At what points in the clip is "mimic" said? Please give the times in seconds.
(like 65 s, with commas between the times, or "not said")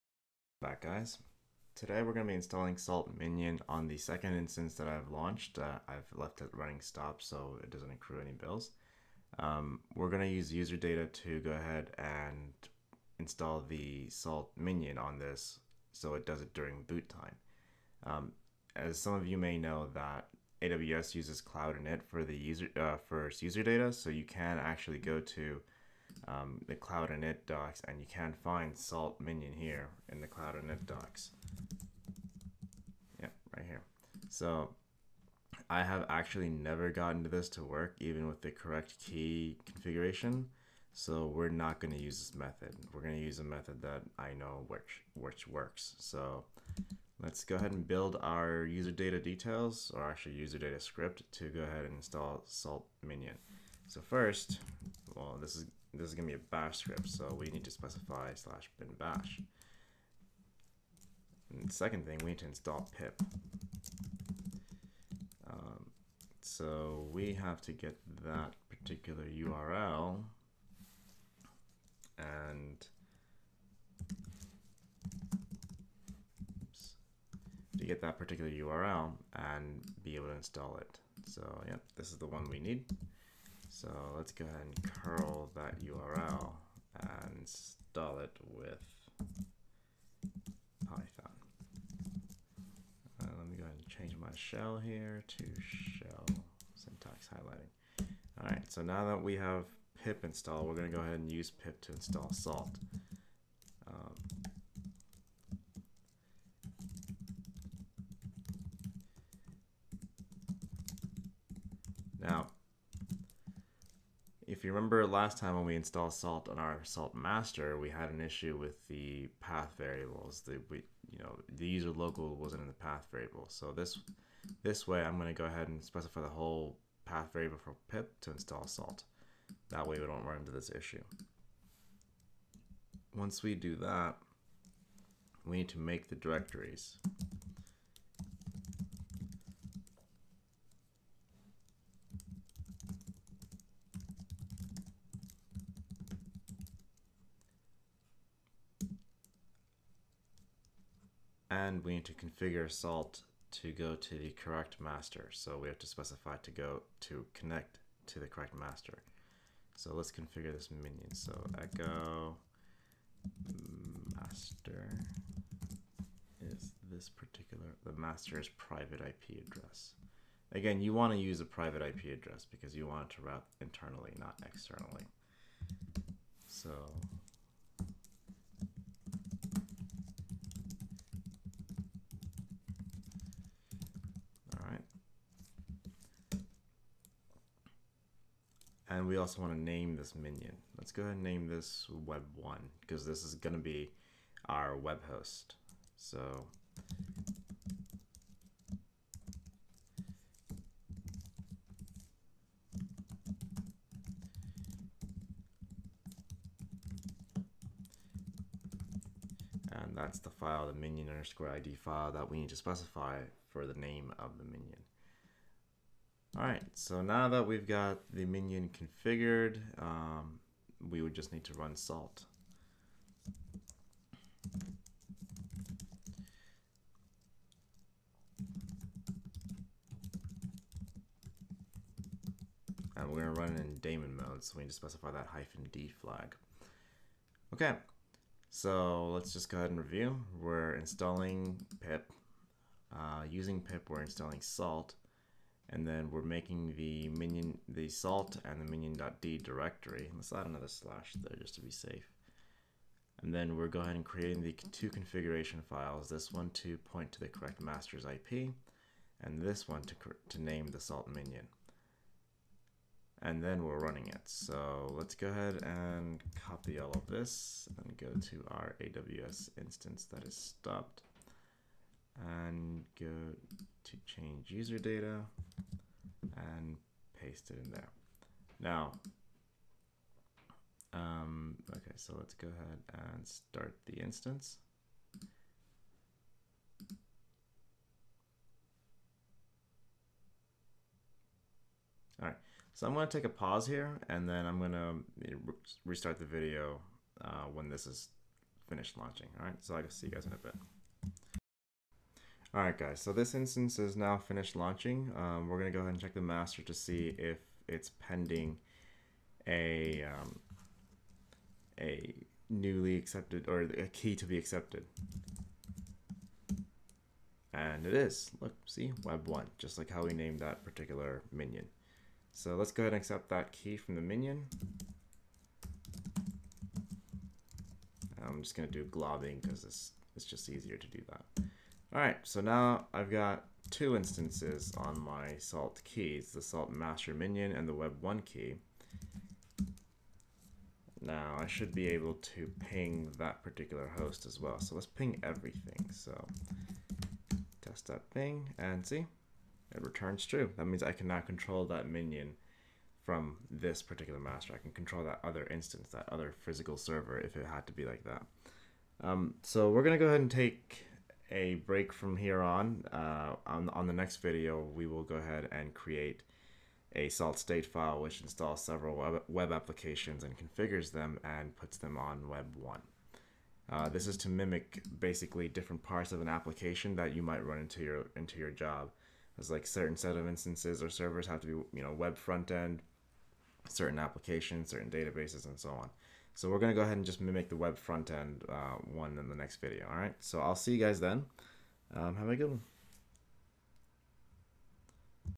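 374 s, 387 s.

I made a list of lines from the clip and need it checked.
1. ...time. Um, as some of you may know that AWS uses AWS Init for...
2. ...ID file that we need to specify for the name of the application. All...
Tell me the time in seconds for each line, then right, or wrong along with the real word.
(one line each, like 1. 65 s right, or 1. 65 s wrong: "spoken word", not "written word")
1. 17 s wrong: "Cloud", not "AWS"
2. 211 s wrong: "minion", not "application".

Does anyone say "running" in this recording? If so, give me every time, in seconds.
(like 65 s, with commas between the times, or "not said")
6 s, 263 s.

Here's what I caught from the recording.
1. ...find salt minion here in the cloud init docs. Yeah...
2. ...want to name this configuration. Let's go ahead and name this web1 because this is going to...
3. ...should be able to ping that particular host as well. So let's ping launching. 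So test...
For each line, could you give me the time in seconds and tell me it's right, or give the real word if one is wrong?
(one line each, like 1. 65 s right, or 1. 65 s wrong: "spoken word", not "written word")
1. 28 s right
2. 189 s wrong: "minion", not "configuration"
3. 341 s wrong: "everything", not "launching".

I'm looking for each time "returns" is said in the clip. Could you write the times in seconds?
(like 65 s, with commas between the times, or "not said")
349 s.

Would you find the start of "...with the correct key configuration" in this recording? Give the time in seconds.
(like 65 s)
38 s.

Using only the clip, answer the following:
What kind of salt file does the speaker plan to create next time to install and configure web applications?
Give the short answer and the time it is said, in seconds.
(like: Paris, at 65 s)
salt state file, at 367 s.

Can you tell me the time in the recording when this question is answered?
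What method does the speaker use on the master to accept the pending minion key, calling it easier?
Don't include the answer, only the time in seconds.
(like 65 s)
328 s.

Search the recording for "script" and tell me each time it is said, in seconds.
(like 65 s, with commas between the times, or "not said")
50 s, 56 s.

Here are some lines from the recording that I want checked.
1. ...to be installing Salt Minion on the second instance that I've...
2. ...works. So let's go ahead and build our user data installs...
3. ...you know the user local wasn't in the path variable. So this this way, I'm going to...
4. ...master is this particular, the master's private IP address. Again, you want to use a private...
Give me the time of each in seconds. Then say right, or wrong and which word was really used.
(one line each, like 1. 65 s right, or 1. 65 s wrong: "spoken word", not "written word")
1. 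2 s right
2. 45 s wrong: "details", not "installs"
3. 121 s right
4. 164 s right.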